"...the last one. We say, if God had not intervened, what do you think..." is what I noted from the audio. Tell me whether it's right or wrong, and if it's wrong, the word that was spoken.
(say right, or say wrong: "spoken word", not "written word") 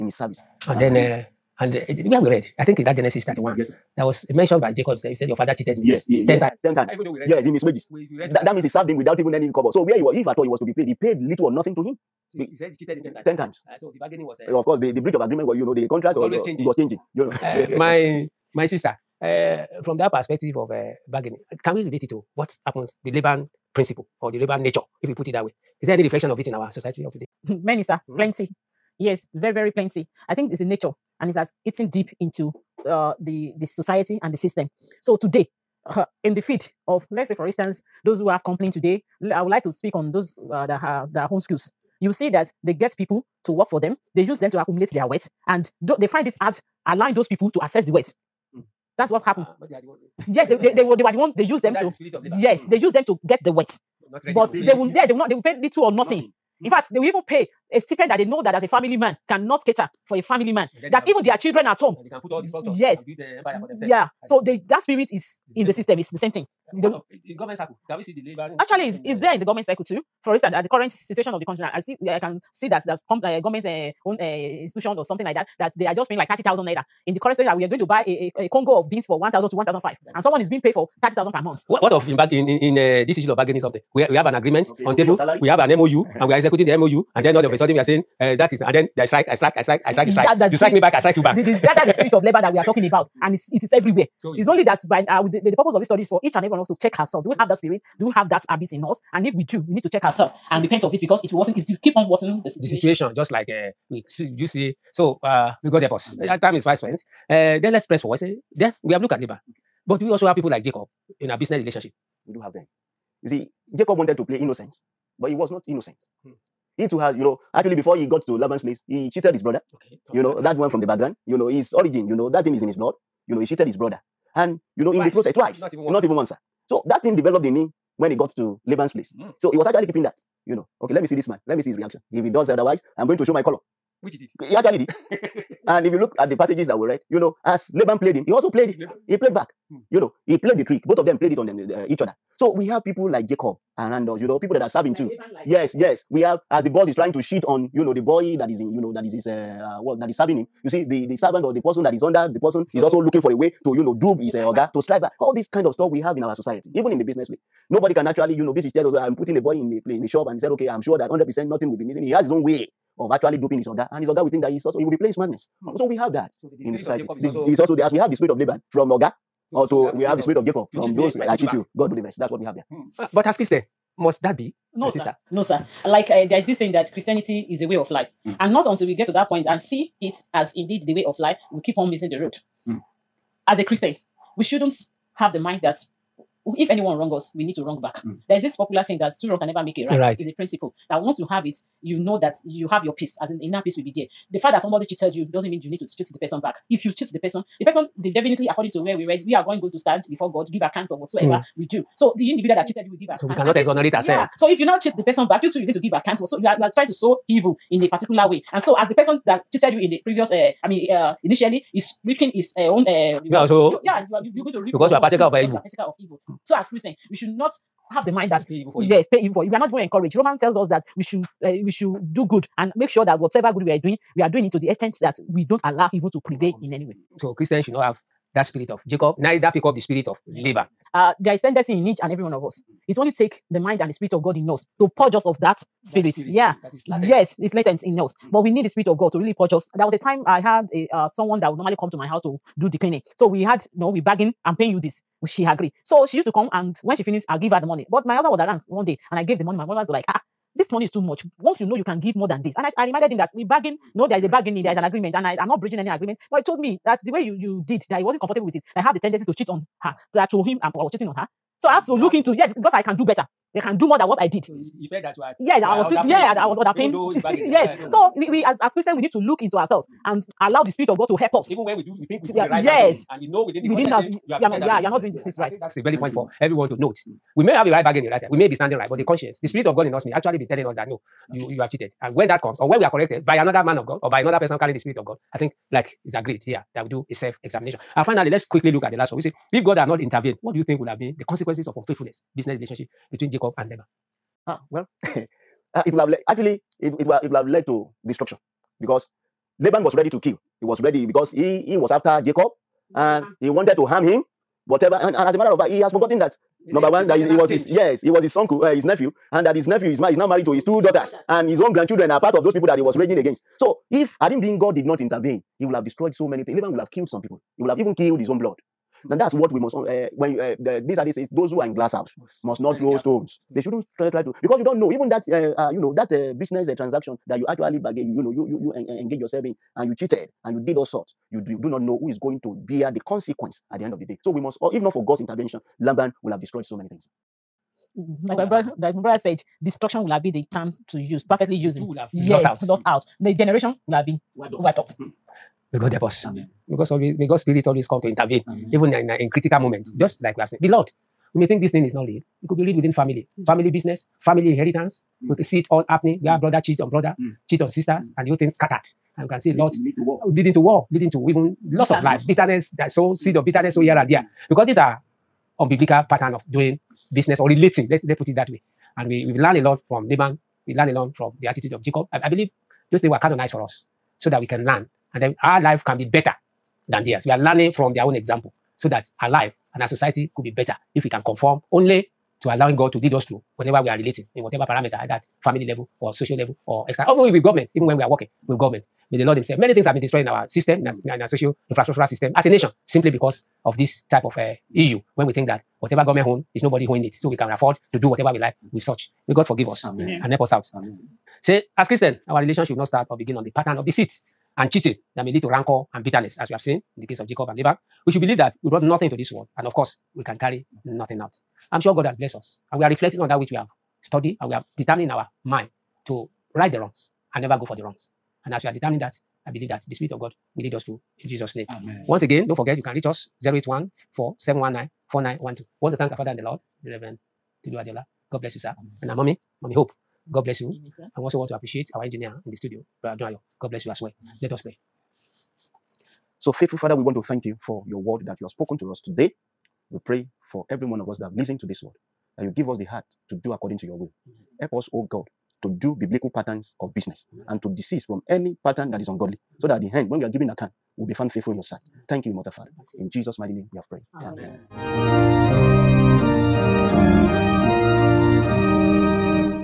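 right.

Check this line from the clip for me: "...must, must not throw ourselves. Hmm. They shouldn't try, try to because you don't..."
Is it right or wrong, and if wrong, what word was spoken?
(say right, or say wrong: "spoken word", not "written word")
wrong: "stones", not "ourselves".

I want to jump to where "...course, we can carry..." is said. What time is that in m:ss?
6:49.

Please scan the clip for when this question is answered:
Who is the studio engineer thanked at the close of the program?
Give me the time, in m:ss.
7:13.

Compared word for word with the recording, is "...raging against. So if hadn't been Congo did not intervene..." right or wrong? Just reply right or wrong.
wrong.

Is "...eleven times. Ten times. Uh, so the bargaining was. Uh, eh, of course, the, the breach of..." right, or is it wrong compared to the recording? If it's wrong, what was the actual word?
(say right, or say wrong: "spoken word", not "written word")
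wrong: "ten", not "eleven".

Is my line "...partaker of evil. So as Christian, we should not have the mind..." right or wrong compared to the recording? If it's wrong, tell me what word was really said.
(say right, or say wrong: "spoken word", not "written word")
right.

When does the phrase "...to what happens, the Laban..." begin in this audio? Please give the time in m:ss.
0:22.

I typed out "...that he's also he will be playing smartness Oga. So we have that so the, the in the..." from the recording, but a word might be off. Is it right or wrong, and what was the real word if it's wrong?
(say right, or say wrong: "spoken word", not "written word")
wrong: "Hmm", not "Oga".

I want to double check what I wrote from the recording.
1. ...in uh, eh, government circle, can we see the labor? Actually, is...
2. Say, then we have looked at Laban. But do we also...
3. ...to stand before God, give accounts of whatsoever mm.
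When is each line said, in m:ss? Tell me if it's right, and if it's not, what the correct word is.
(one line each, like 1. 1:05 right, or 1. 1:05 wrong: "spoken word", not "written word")
1. 1:06 right
2. 1:48 right
3. 3:19 right.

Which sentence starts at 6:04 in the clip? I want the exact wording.
because these are unbiblical pattern of doing business or relating.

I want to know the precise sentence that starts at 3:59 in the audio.
There was a time I had a uh, someone that would normally come to my house to do the cleaning.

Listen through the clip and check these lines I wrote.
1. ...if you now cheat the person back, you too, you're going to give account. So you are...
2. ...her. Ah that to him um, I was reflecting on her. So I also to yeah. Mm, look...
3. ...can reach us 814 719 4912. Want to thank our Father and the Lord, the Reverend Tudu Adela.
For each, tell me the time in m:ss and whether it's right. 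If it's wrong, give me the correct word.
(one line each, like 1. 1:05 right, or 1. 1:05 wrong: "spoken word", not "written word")
1. 3:24 right
2. 4:19 wrong: "cheating", not "reflecting"
3. 7:02 right.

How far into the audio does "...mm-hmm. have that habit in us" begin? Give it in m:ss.
1:38.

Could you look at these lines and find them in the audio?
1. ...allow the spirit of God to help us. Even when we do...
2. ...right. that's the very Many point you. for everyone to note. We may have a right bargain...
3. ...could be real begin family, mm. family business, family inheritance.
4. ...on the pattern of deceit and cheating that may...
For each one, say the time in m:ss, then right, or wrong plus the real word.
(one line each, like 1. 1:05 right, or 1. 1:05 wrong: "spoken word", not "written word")
1. 4:30 right
2. 4:35 wrong: "Thank", not "Many"
3. 5:52 wrong: "within", not "begin"
4. 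6:43 right.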